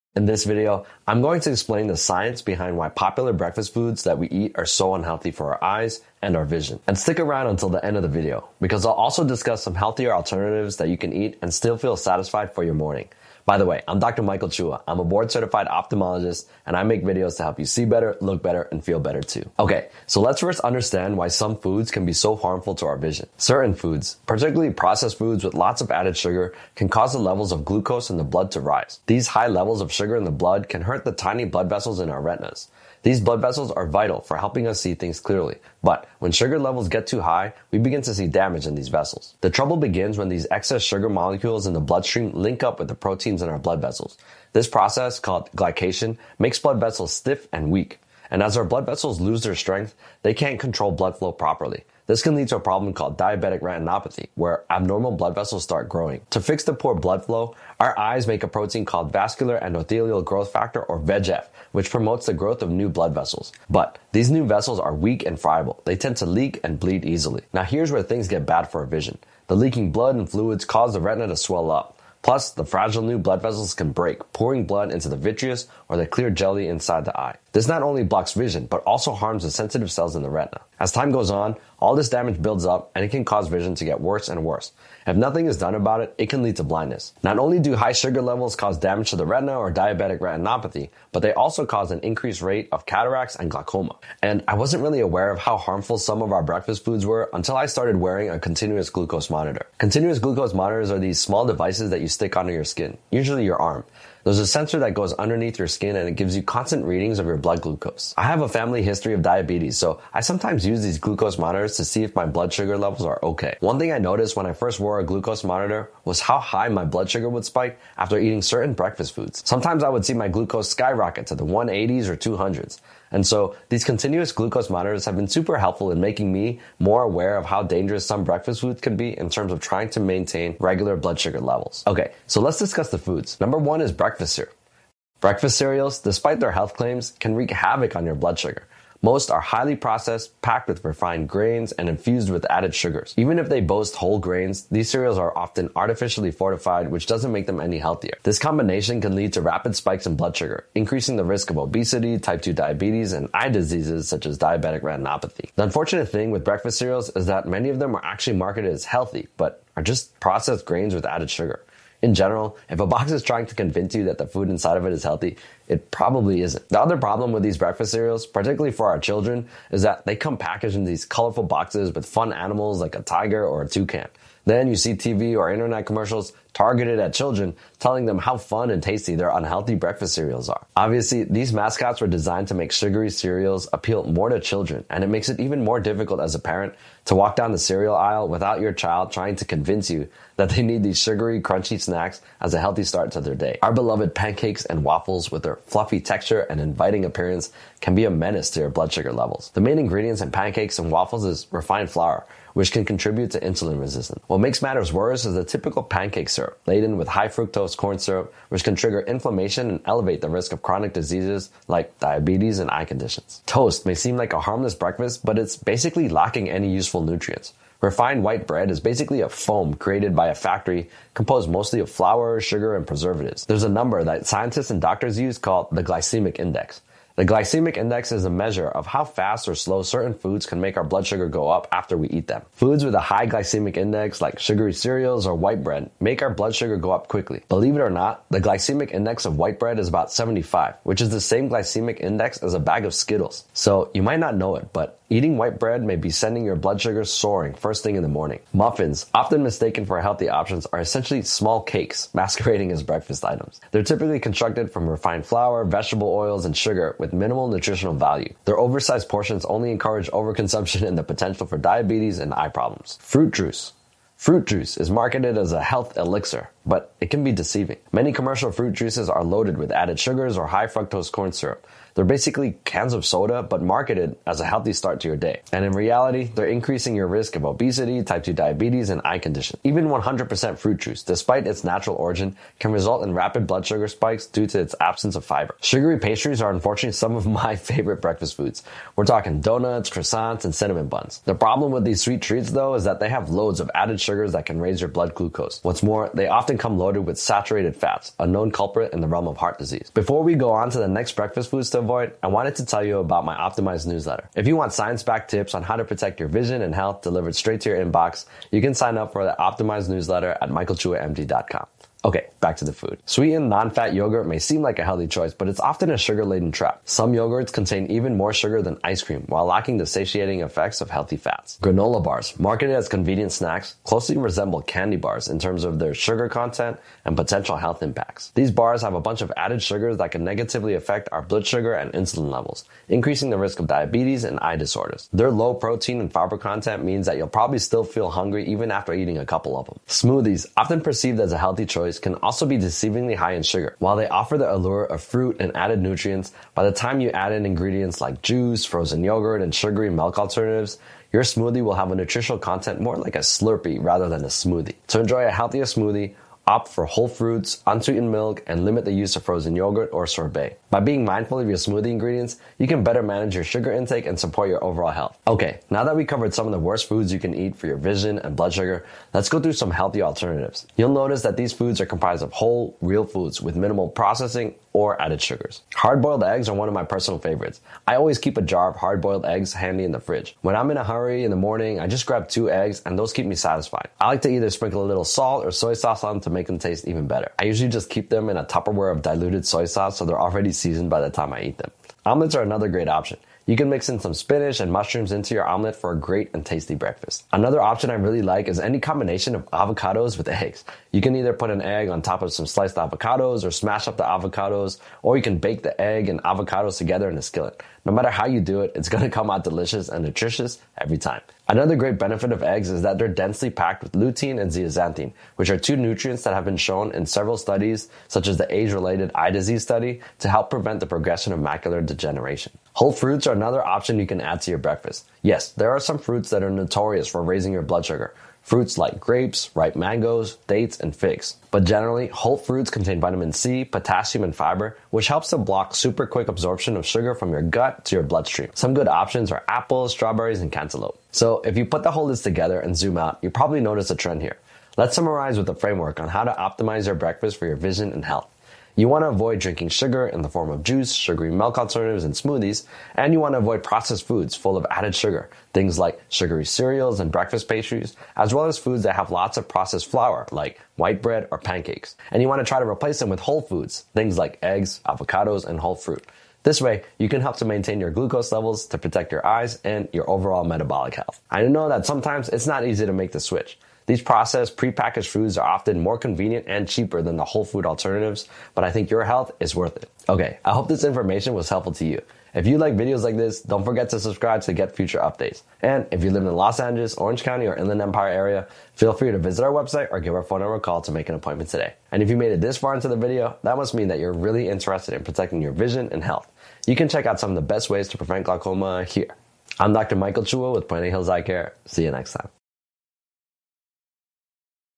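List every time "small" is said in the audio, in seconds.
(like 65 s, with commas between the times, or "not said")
101 s, 251 s.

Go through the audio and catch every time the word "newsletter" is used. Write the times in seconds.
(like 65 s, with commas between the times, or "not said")
303 s, 309 s.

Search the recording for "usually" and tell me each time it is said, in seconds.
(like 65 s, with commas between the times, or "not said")
103 s, 387 s.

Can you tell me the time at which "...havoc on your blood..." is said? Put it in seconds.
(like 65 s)
137 s.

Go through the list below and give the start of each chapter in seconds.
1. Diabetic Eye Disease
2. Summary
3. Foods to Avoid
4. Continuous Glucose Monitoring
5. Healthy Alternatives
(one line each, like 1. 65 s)
1. 19 s
2. 441 s
3. 132 s
4. 95 s
5. 365 s.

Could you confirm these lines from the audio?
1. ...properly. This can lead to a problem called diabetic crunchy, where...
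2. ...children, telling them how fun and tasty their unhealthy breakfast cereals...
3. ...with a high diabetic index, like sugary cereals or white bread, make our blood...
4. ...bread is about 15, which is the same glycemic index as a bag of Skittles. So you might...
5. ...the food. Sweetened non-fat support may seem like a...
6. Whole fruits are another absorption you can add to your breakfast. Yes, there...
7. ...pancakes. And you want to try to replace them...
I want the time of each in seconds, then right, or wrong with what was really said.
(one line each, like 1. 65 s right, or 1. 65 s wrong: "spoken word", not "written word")
1. 51 s wrong: "retinopathy", not "crunchy"
2. 177 s right
3. 232 s wrong: "glycemic", not "diabetic"
4. 239 s wrong: "75", not "15"
5. 312 s wrong: "yogurt", not "support"
6. 422 s wrong: "option", not "absorption"
7. 461 s right.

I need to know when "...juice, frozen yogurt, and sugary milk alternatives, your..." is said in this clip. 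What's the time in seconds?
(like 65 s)
348 s.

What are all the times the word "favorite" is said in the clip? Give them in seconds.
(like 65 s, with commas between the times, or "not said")
287 s, 377 s.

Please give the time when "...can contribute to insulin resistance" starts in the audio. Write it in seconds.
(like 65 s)
202 s.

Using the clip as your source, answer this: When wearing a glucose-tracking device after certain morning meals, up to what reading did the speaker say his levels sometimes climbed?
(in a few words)
200s.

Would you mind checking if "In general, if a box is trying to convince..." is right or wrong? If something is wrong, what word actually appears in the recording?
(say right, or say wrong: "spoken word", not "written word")
right.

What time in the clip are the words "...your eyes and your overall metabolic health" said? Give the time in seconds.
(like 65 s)
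469 s.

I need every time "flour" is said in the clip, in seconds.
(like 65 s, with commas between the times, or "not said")
201 s, 221 s, 255 s, 459 s.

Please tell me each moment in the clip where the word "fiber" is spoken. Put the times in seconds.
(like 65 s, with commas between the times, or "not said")
285 s, 336 s, 434 s.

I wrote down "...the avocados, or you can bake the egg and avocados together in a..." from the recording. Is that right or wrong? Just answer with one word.
right.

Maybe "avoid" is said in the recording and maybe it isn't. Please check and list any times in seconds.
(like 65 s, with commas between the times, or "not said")
301 s, 449 s, 453 s.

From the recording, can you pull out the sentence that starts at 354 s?
To enjoy a healthier smoothie, Opt for whole fruits, unsweetened milk, and limit the use of frozen yogurt or sorbet.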